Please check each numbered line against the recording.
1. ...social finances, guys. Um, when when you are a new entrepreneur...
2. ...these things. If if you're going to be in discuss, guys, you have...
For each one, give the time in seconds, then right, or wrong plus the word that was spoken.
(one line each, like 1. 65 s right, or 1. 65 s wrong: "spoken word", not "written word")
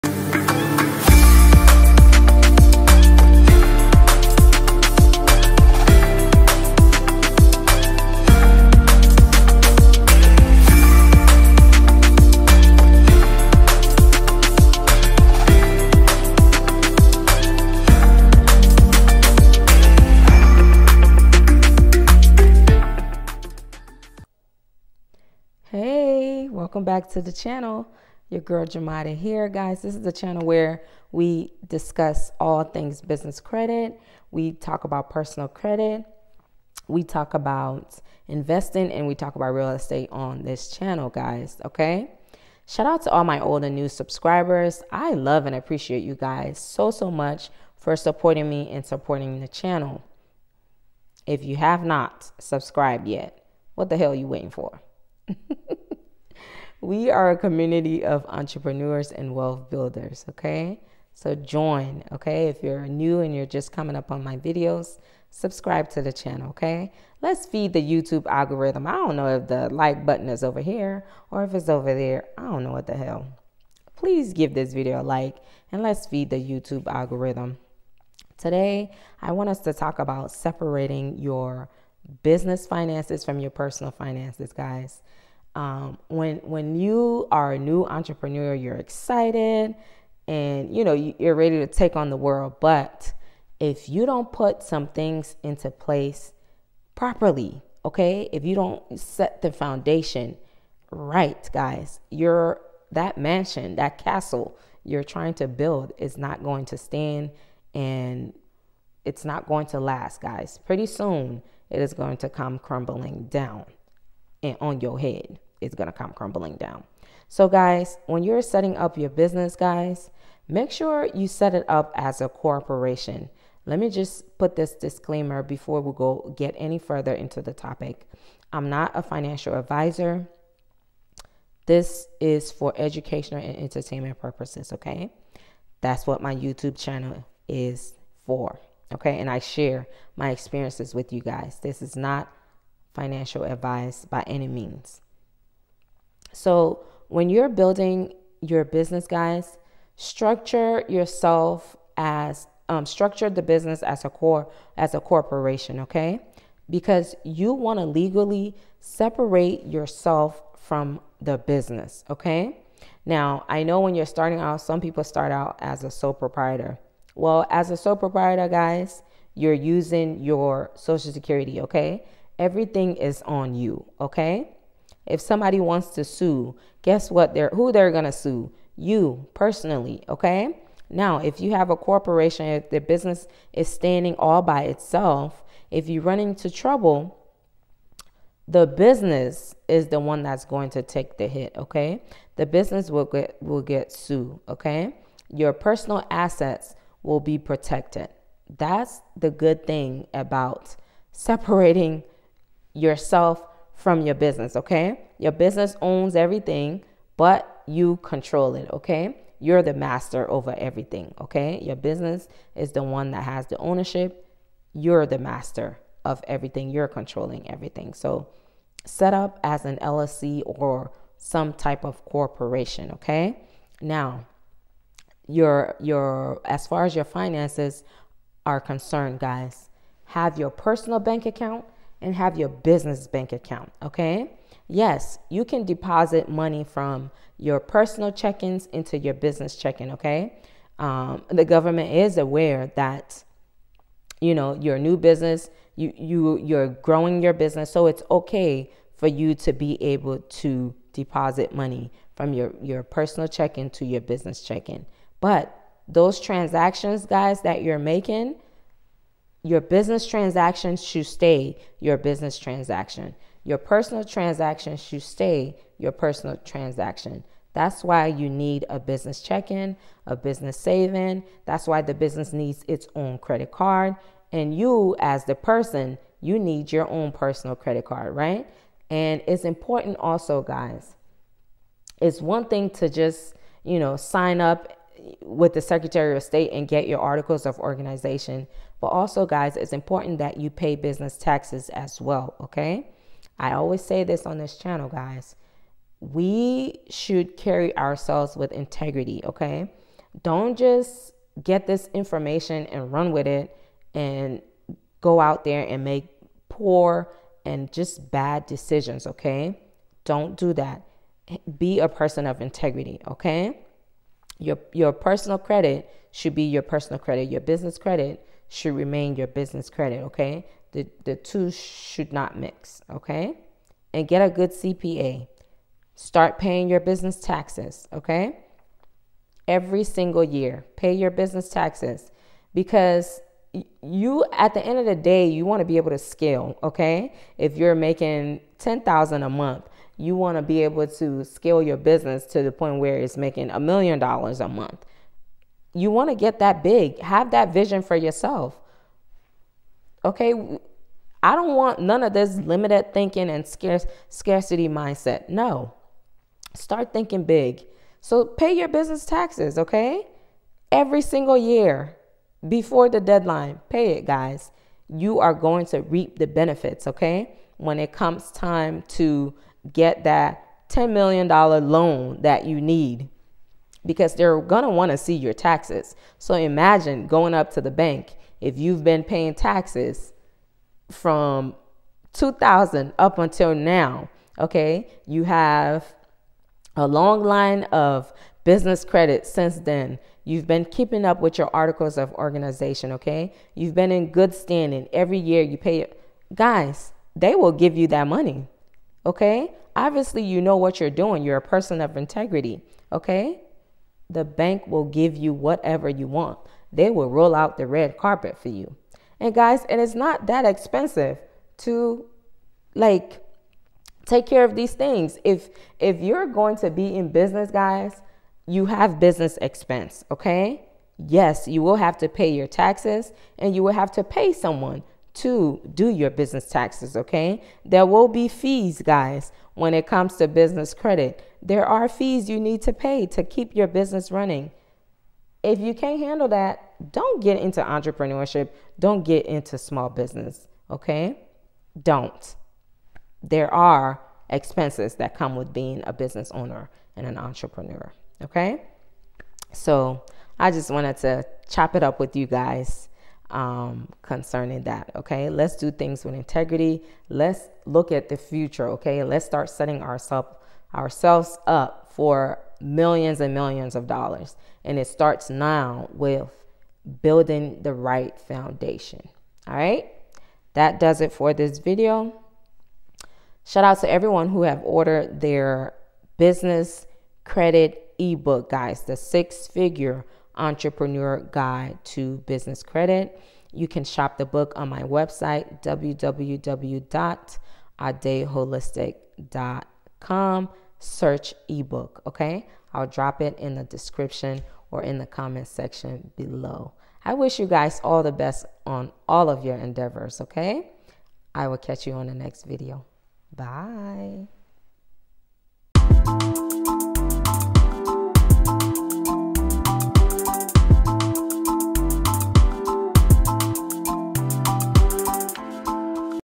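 1. 83 s wrong: "personal", not "social"
2. 414 s wrong: "business", not "discuss".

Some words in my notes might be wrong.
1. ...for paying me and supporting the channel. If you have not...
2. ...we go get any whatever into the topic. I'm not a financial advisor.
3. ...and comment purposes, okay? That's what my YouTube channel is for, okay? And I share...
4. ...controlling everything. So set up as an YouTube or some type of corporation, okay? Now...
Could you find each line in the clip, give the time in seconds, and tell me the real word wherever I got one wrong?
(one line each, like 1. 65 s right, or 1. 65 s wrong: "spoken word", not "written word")
1. 47 s wrong: "supporting", not "paying"
2. 125 s wrong: "further", not "whatever"
3. 133 s wrong: "entertainment", not "comment"
4. 216 s wrong: "LLC", not "YouTube".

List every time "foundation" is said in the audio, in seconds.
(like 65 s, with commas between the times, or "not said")
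99 s, 468 s.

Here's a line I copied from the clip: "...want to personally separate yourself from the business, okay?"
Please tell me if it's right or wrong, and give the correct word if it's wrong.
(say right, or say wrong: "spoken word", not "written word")
wrong: "legally", not "personally".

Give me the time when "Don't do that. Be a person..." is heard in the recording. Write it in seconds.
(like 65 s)
310 s.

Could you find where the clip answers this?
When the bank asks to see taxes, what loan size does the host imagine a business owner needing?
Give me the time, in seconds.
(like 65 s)
370 s.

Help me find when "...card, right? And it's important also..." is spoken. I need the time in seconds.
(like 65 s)
277 s.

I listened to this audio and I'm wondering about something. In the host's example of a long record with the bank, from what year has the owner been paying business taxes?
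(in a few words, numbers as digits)
2000.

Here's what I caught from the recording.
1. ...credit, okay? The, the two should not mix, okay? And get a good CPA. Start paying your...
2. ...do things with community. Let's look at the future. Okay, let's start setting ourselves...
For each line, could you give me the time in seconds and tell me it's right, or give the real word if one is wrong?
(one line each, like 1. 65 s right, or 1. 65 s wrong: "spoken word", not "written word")
1. 319 s right
2. 455 s wrong: "integrity", not "community".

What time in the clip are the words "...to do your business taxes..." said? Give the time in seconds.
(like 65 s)
425 s.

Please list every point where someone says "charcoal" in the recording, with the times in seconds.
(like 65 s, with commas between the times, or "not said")
not said.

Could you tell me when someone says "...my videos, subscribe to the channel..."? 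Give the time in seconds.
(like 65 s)
64 s.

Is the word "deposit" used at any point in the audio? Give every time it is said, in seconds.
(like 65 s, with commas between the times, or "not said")
235 s, 250 s.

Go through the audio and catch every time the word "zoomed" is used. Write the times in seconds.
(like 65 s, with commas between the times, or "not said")
not said.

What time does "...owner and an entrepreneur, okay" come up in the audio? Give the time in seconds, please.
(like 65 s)
446 s.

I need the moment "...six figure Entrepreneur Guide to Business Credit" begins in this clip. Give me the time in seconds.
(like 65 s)
478 s.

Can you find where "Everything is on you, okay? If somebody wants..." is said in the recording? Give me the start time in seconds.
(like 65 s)
172 s.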